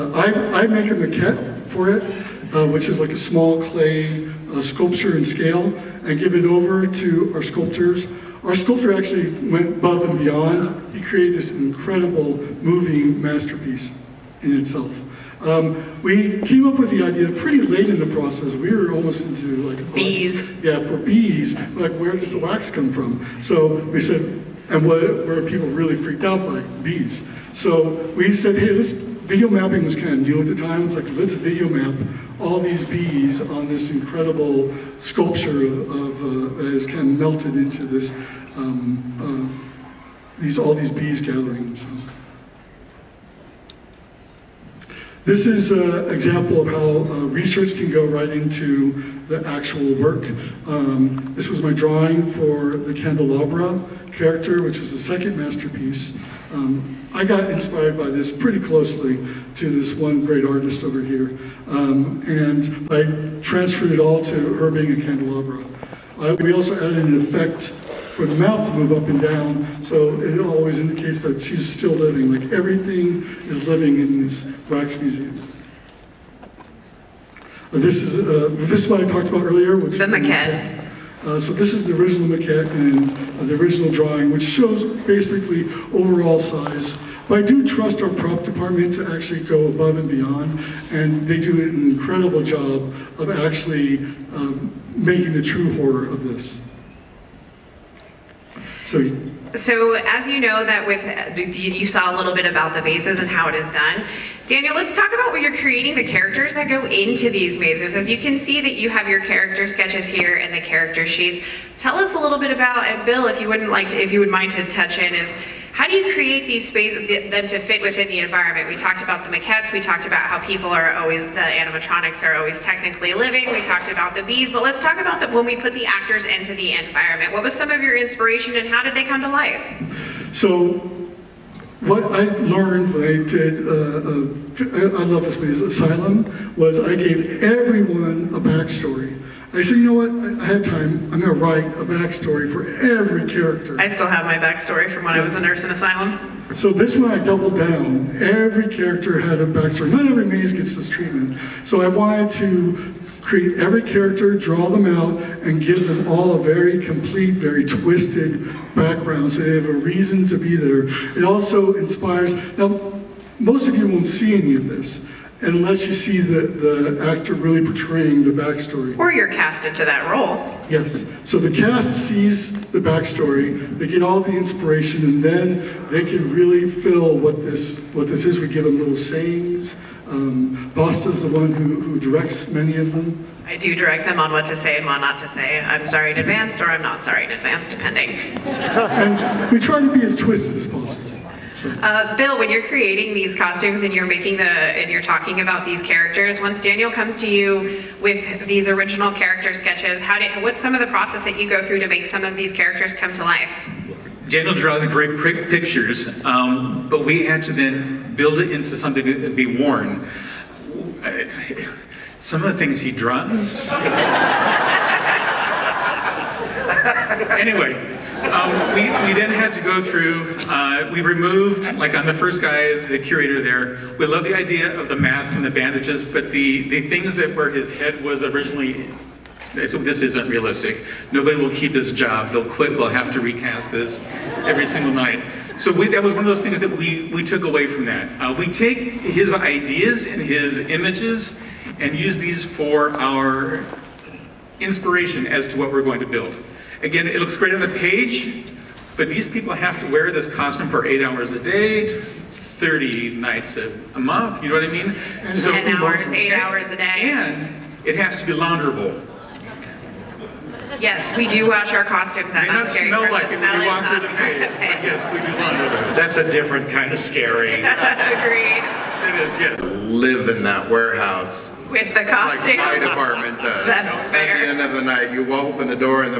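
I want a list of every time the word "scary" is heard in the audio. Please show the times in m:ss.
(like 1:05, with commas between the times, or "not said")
4:22, 4:26.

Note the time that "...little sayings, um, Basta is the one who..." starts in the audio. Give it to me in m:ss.
2:58.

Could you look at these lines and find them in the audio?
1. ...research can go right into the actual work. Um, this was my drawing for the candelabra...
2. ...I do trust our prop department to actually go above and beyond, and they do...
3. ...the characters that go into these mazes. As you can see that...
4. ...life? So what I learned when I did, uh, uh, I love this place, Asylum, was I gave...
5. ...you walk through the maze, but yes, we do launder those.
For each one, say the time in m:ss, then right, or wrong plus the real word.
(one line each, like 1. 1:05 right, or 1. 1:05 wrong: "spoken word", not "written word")
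1. 0:47 right
2. 1:27 right
3. 1:45 right
4. 2:09 right
5. 4:23 right.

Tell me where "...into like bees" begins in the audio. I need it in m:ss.
0:19.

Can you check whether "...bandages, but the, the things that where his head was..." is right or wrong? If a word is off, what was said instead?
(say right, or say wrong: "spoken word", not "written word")
right.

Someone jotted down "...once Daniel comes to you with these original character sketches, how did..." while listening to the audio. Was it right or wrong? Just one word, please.
right.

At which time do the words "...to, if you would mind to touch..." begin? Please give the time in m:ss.
1:53.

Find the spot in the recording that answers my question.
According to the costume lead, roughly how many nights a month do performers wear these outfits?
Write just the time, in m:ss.
4:11.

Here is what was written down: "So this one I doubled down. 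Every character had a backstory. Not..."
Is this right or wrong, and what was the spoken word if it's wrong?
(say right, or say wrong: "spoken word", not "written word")
right.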